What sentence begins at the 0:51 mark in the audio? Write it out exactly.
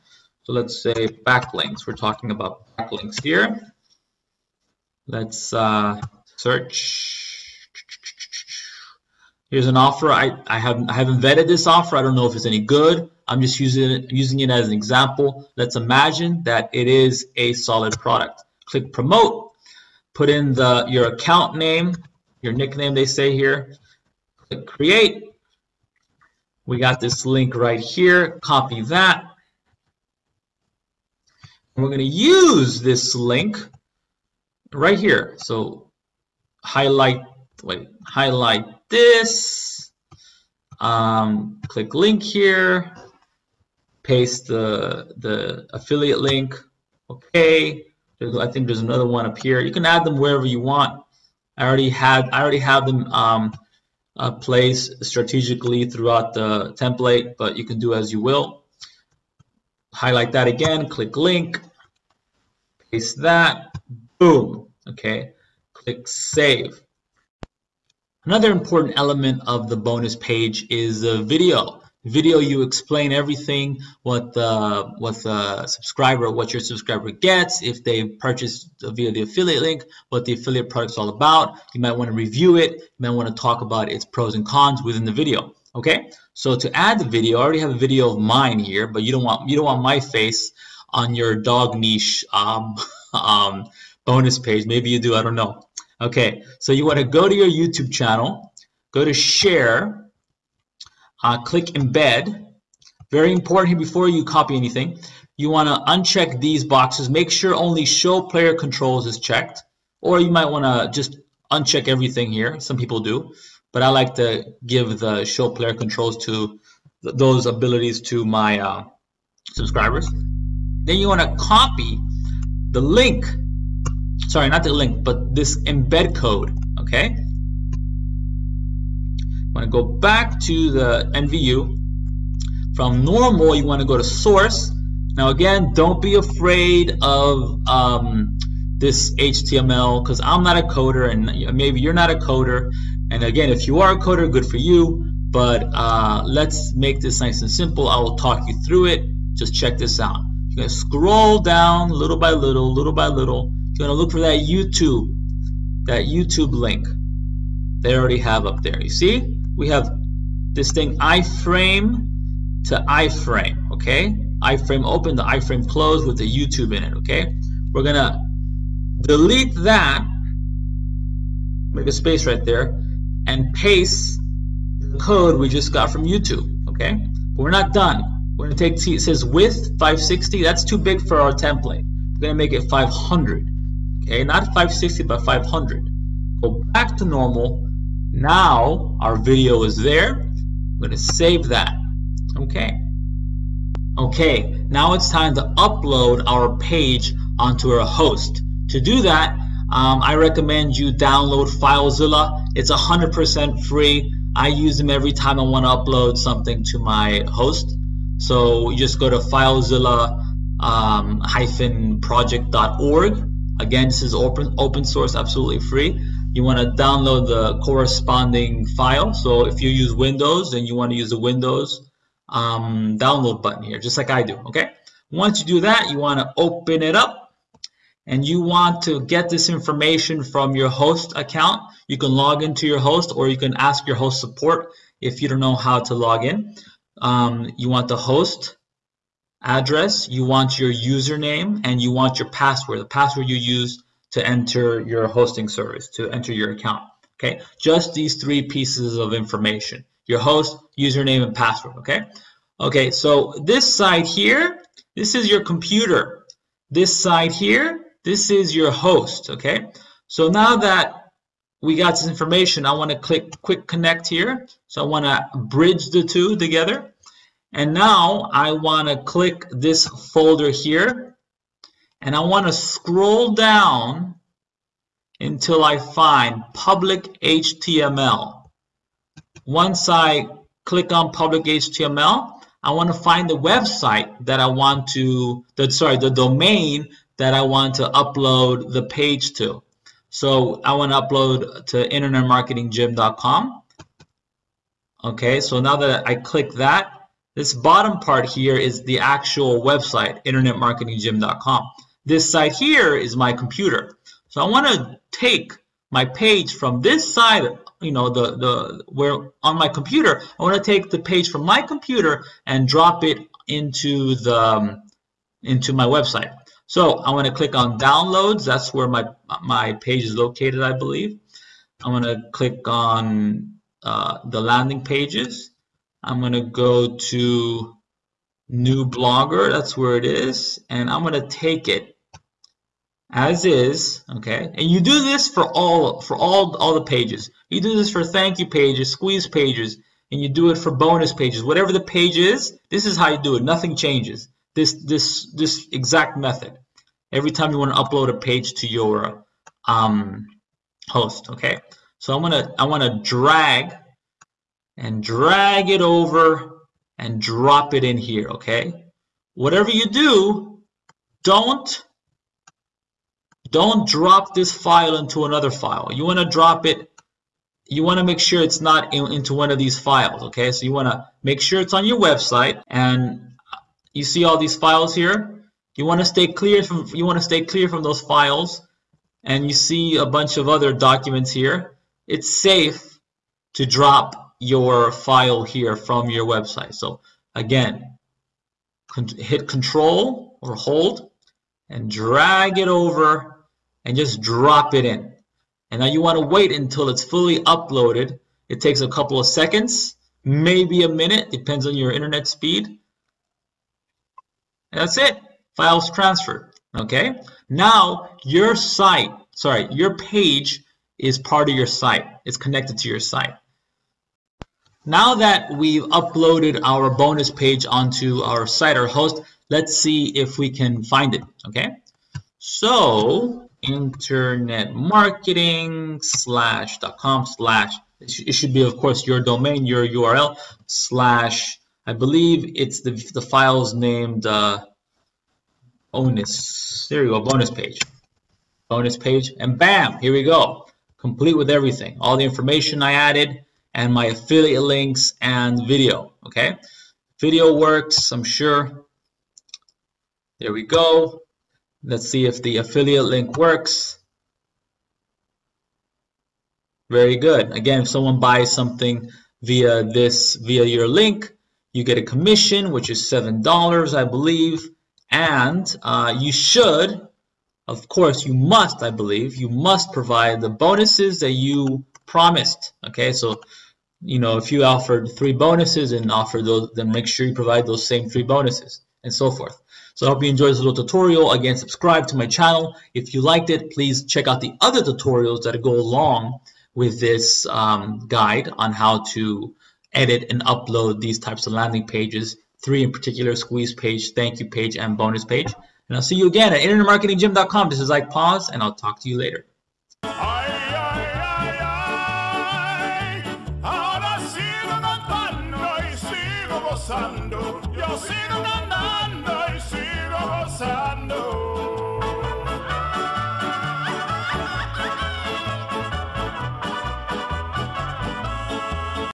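I already had I already have them um, uh, placed strategically throughout the template, but you can do as you will.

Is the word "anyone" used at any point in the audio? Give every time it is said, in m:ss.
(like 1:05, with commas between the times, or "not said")
not said.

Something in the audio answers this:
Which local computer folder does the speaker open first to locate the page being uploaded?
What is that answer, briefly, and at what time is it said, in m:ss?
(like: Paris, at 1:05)
downloads, at 5:17.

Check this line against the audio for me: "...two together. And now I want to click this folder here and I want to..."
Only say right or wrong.
right.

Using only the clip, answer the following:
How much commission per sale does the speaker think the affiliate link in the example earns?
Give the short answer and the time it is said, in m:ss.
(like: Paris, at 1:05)
$7, at 7:43.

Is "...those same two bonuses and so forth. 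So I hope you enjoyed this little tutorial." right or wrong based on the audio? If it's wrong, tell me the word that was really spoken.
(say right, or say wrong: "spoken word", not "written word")
wrong: "three", not "two".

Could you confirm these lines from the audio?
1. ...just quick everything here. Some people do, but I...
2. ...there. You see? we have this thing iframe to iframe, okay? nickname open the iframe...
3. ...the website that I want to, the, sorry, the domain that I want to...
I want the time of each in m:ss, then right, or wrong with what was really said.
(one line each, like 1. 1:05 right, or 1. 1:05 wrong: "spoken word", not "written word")
1. 1:50 wrong: "uncheck", not "quick"
2. 2:38 wrong: "iframe", not "nickname"
3. 4:43 right.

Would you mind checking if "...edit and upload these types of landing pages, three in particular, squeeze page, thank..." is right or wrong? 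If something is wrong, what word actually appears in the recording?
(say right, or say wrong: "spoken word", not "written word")
right.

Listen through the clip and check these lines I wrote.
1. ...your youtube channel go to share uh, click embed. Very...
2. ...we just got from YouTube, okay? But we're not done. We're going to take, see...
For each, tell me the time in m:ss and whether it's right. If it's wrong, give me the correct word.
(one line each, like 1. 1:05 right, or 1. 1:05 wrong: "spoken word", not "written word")
1. 1:37 right
2. 2:55 right.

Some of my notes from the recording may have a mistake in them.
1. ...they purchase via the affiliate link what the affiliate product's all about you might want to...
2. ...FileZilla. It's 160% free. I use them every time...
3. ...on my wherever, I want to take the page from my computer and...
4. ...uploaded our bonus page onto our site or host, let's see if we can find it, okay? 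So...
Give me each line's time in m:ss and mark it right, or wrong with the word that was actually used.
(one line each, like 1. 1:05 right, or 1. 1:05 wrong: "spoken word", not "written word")
1. 1:17 right
2. 3:21 wrong: "100", not "160"
3. 5:09 wrong: "computer", not "wherever"
4. 6:55 right.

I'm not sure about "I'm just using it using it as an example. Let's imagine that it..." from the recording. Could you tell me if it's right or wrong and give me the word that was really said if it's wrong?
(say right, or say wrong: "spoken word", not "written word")
right.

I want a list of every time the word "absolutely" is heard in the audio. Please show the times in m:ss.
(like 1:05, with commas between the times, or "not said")
3:35.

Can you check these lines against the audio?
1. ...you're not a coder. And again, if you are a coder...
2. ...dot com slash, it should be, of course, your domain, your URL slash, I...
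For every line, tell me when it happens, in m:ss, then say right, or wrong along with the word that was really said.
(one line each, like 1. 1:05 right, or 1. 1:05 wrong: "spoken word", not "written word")
1. 2:21 right
2. 7:06 right.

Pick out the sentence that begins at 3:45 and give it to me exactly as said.
Once you do that, you want to open it up and you want to get this information from your host account.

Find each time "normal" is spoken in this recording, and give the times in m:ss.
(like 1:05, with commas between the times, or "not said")
2:13, 3:07.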